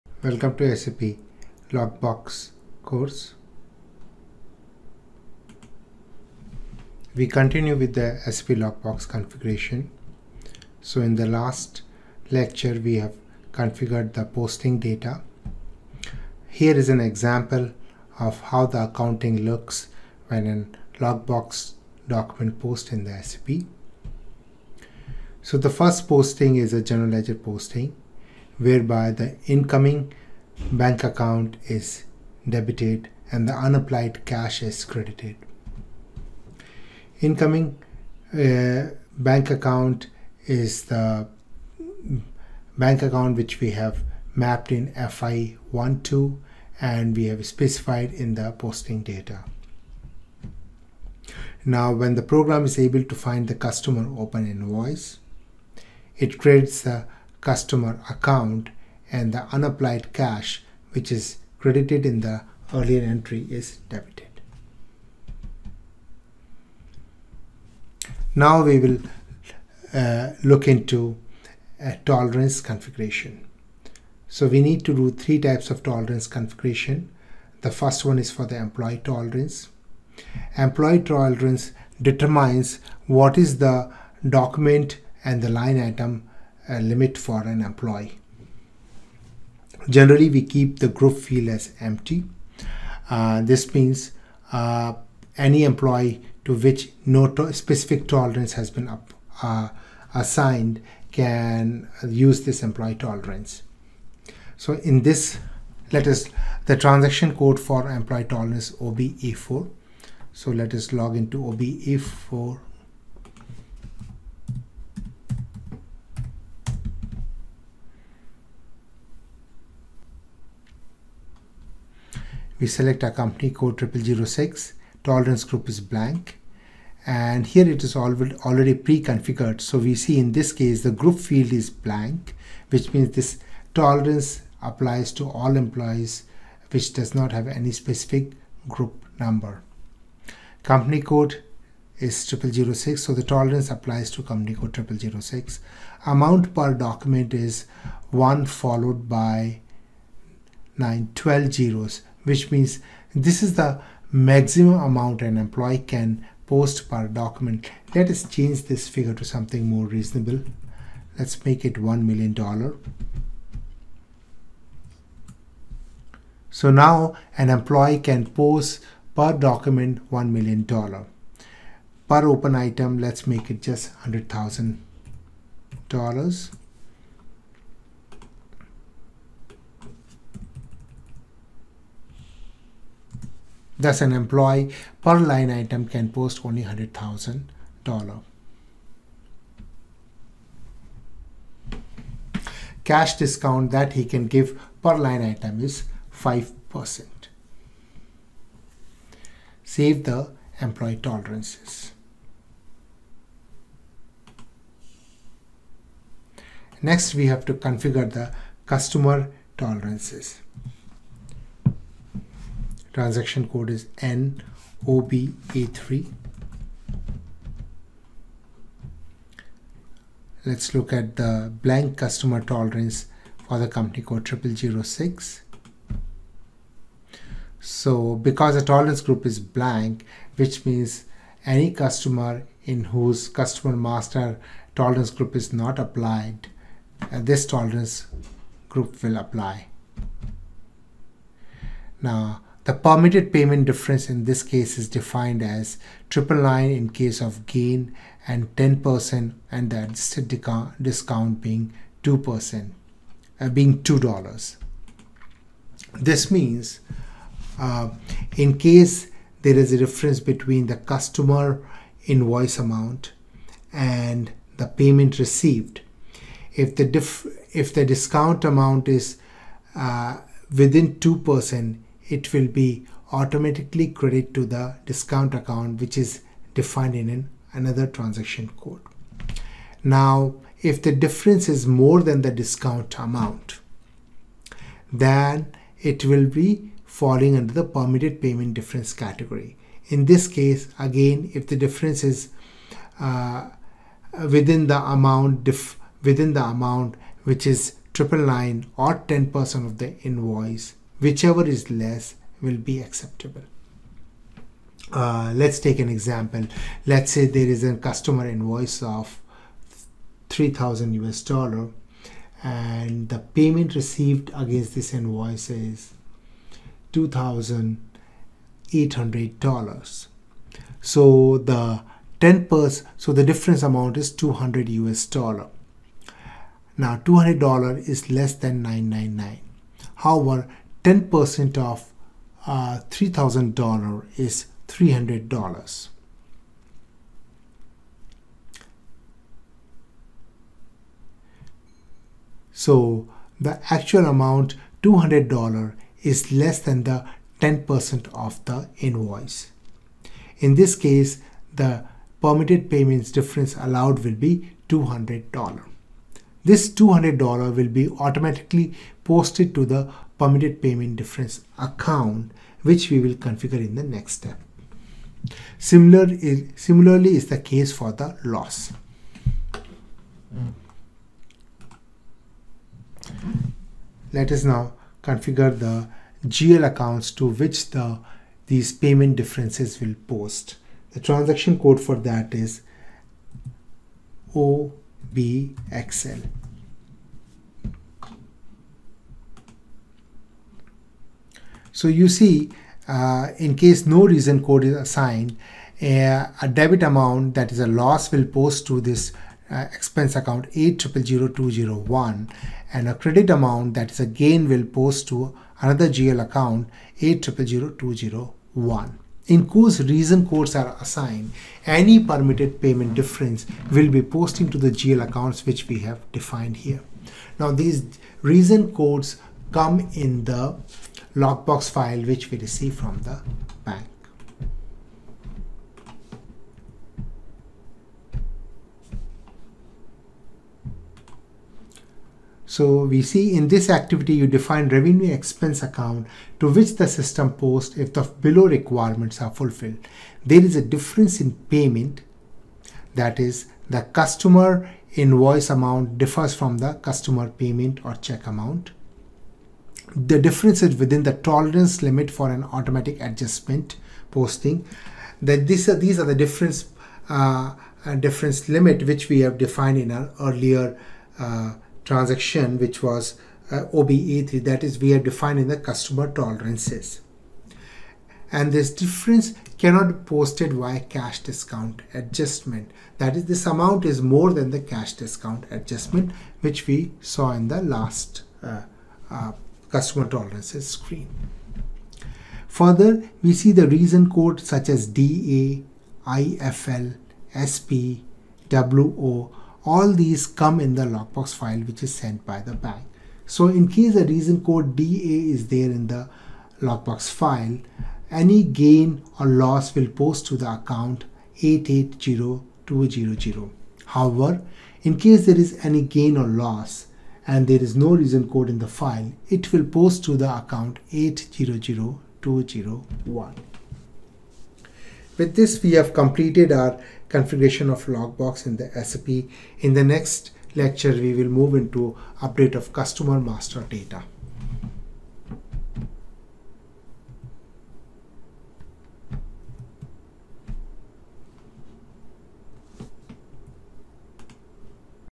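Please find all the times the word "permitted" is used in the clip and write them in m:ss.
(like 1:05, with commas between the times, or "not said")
4:02, 4:47, 5:52, 6:00, 6:52.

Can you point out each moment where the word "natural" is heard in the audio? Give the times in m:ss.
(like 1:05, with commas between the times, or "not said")
not said.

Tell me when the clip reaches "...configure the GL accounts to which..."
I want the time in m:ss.
6:15.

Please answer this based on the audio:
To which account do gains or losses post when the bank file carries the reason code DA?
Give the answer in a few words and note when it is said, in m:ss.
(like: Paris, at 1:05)
880200, at 8:21.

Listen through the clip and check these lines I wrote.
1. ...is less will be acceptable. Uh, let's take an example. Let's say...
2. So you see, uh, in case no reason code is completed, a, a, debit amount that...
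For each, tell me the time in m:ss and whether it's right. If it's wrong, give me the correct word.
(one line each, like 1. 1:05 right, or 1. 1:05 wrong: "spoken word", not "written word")
1. 5:01 right
2. 6:31 wrong: "assigned", not "completed".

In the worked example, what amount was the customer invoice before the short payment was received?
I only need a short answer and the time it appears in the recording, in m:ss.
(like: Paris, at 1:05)
3000 US dollars, at 5:10.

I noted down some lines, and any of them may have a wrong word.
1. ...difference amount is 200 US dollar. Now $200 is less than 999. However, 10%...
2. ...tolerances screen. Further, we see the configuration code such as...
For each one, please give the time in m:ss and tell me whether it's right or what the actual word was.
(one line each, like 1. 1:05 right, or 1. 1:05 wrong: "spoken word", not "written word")
1. 5:23 right
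2. 8:00 wrong: "reason", not "configuration".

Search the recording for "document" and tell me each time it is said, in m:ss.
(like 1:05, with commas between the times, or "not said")
0:22, 1:24, 2:26, 2:37, 2:49.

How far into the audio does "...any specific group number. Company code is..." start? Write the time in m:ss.
2:17.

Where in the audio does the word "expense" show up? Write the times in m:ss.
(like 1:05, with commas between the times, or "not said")
6:39, 7:15.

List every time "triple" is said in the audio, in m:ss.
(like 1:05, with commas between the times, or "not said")
4:06, 4:57.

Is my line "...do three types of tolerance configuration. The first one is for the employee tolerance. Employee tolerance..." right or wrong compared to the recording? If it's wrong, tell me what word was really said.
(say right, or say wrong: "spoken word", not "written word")
right.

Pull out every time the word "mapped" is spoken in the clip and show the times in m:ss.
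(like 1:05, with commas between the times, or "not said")
0:44.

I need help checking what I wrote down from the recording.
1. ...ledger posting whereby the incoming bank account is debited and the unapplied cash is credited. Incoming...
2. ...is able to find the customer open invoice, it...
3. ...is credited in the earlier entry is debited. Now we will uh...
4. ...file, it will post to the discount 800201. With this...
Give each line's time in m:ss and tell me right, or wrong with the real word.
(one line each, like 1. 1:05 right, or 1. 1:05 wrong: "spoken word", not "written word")
1. 0:27 right
2. 0:52 right
3. 1:01 right
4. 8:28 wrong: "account", not "discount".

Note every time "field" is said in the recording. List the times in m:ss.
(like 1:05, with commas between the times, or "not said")
1:31, 2:11.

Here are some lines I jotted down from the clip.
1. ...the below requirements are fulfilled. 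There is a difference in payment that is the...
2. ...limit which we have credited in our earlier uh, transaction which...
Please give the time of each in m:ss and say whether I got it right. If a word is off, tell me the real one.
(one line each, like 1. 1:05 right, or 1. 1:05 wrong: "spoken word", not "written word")
1. 7:17 right
2. 7:38 wrong: "defined", not "credited".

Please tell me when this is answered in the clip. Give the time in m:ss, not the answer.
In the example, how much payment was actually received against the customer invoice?
5:16.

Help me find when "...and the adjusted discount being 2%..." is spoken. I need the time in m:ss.
4:09.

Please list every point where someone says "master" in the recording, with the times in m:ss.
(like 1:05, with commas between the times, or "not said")
3:53, 8:43.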